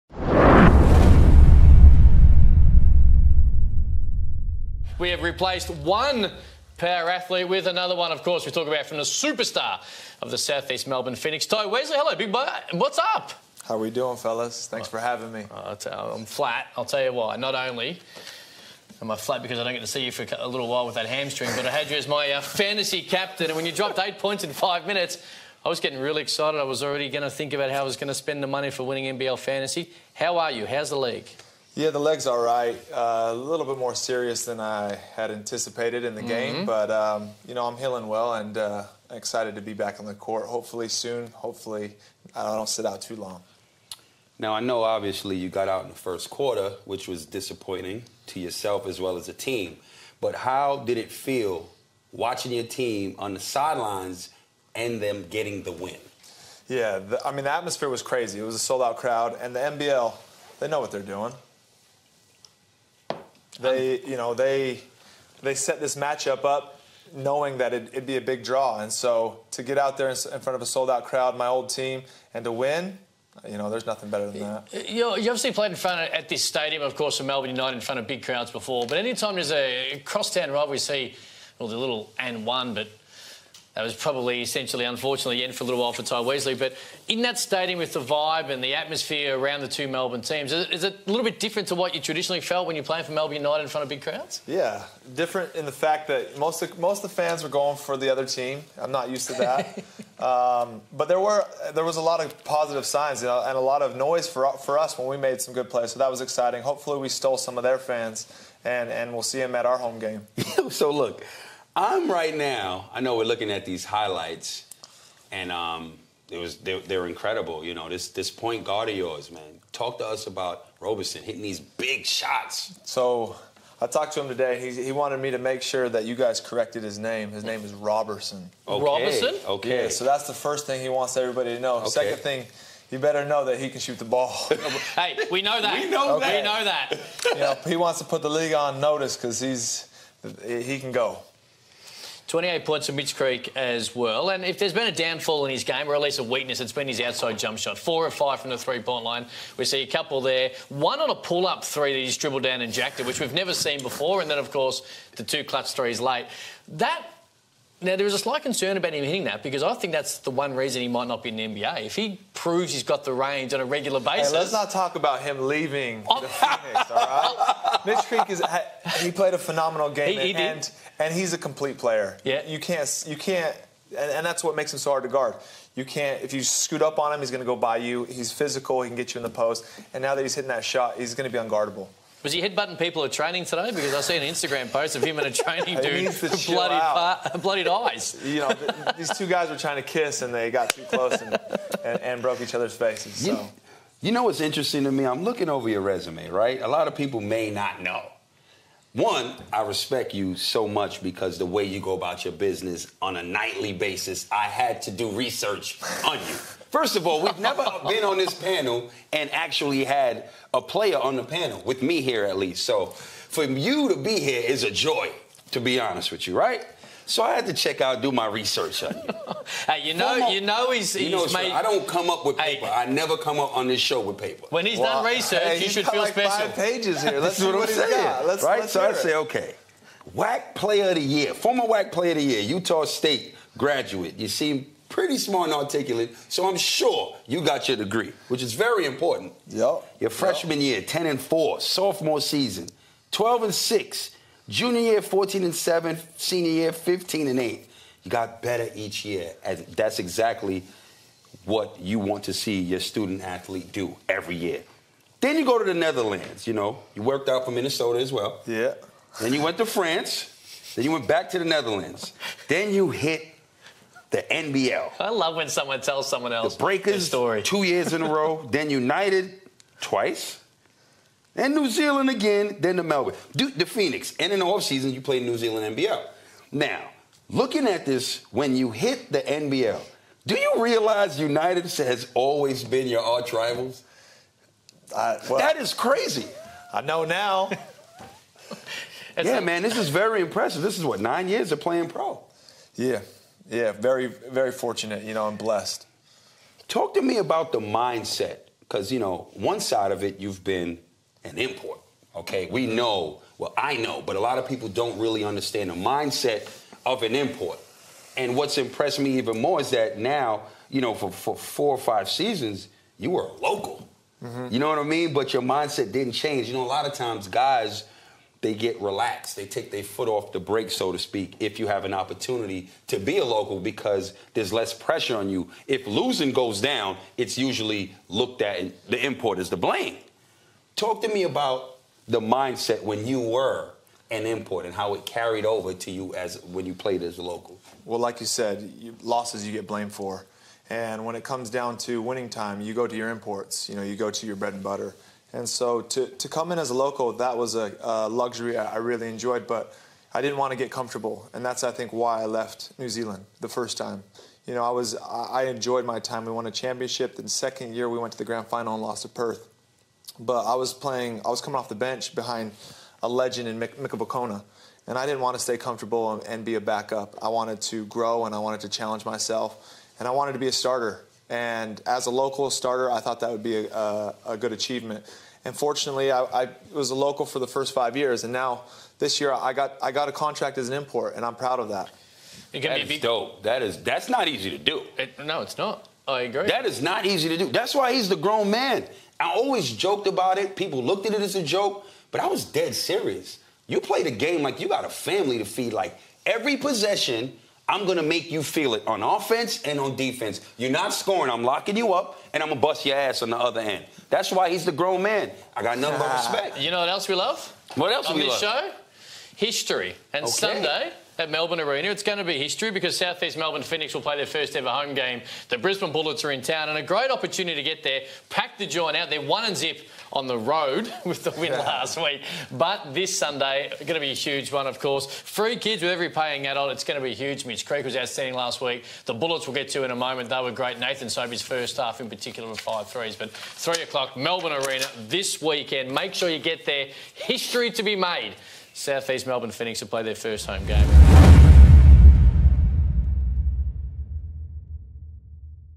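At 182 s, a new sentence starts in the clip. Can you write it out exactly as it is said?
Was he headbutting people at training today?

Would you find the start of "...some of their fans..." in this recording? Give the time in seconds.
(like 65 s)
107 s.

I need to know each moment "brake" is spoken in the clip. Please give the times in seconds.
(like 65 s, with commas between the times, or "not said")
320 s.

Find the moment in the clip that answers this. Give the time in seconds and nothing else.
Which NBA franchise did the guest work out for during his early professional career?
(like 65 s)
257 s.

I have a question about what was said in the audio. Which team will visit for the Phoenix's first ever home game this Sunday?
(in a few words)
Brisbane Bullets.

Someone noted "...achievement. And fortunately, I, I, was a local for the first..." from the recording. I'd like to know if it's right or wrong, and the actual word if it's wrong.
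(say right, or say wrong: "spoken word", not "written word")
right.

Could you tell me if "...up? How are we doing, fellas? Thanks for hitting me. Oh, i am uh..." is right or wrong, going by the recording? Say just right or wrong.
wrong.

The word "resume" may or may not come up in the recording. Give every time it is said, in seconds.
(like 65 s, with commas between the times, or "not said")
195 s.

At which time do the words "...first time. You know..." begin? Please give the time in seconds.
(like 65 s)
353 s.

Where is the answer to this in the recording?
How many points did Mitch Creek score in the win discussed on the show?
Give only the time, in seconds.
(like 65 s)
142 s.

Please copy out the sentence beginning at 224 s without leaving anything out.
When he's well, done research, hey, you should feel like special.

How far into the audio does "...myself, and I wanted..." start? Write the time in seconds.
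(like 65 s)
369 s.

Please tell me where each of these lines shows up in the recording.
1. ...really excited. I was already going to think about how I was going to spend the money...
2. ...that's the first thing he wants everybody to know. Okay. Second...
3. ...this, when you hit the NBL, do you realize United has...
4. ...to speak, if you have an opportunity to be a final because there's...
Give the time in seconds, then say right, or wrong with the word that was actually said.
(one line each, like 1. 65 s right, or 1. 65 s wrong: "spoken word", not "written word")
1. 25 s right
2. 130 s right
3. 277 s right
4. 320 s wrong: "local", not "final".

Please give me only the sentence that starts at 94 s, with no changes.
Yeah, different in the fact that most of, most of the fans were going for the other team.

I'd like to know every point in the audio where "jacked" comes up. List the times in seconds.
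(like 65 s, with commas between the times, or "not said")
152 s.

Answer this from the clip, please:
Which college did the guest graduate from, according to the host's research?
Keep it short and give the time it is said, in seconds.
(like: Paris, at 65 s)
Utah State, at 232 s.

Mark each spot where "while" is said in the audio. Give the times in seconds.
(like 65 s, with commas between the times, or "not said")
20 s, 85 s.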